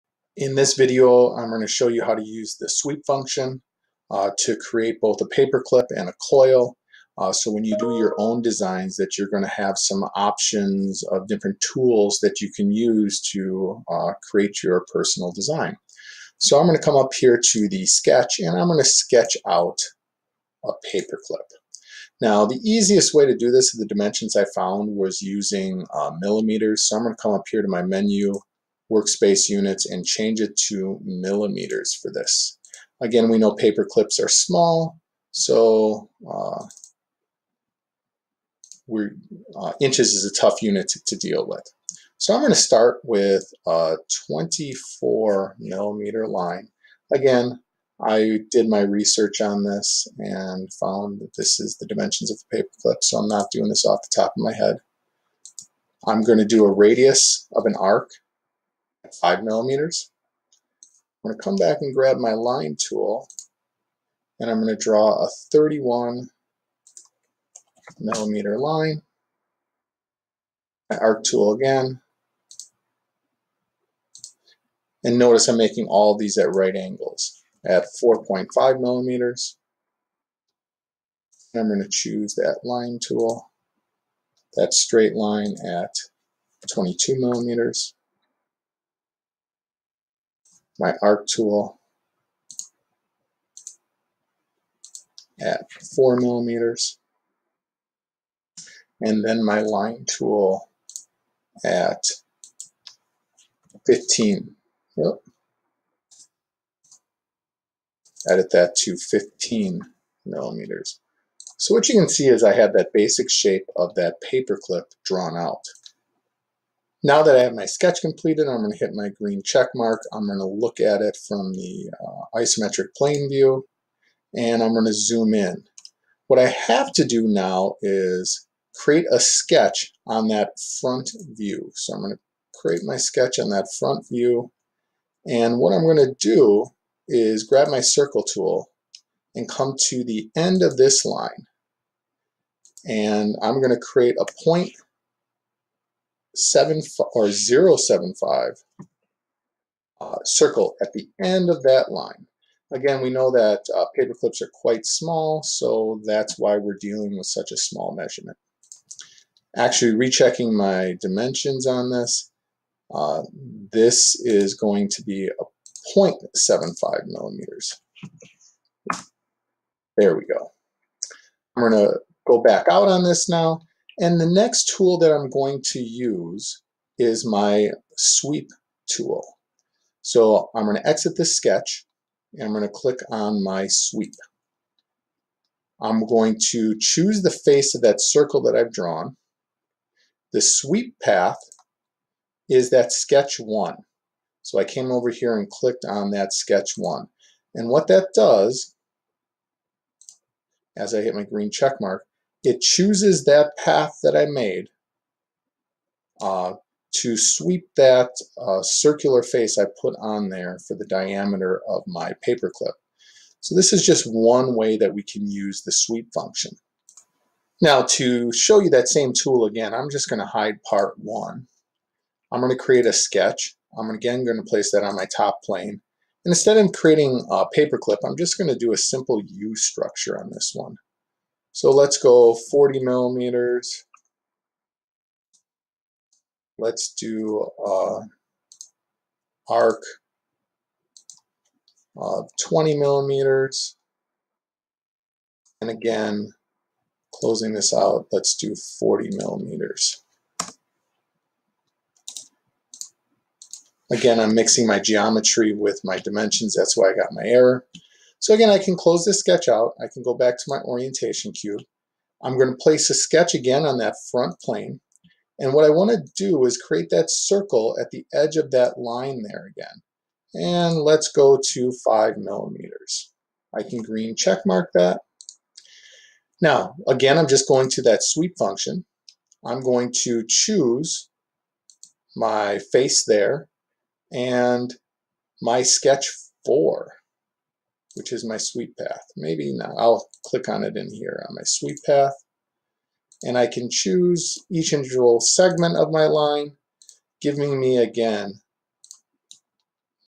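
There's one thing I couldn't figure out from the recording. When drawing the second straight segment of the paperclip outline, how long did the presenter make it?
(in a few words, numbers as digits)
31 millimeters.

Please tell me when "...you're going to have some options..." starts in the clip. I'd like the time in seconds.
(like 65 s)
9 s.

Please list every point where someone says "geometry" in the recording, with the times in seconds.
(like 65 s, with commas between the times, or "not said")
254 s.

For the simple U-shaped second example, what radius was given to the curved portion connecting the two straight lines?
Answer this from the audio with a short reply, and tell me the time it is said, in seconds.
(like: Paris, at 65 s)
20 millimeters, at 242 s.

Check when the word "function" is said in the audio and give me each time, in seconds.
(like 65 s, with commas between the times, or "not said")
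3 s, 216 s, 278 s.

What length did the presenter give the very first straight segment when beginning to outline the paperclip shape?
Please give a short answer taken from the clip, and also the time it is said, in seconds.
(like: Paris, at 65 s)
24 millimeters, at 44 s.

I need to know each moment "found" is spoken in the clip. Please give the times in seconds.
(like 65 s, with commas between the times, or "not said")
24 s, 50 s.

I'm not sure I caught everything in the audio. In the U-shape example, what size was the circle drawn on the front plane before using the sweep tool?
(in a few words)
5 millimeters.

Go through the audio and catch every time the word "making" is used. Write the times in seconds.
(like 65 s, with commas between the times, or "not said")
75 s.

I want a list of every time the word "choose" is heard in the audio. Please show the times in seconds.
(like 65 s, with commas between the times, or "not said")
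81 s, 186 s, 202 s, 280 s, 293 s.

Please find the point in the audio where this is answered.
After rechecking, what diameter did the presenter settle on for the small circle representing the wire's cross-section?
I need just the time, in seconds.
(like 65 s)
165 s.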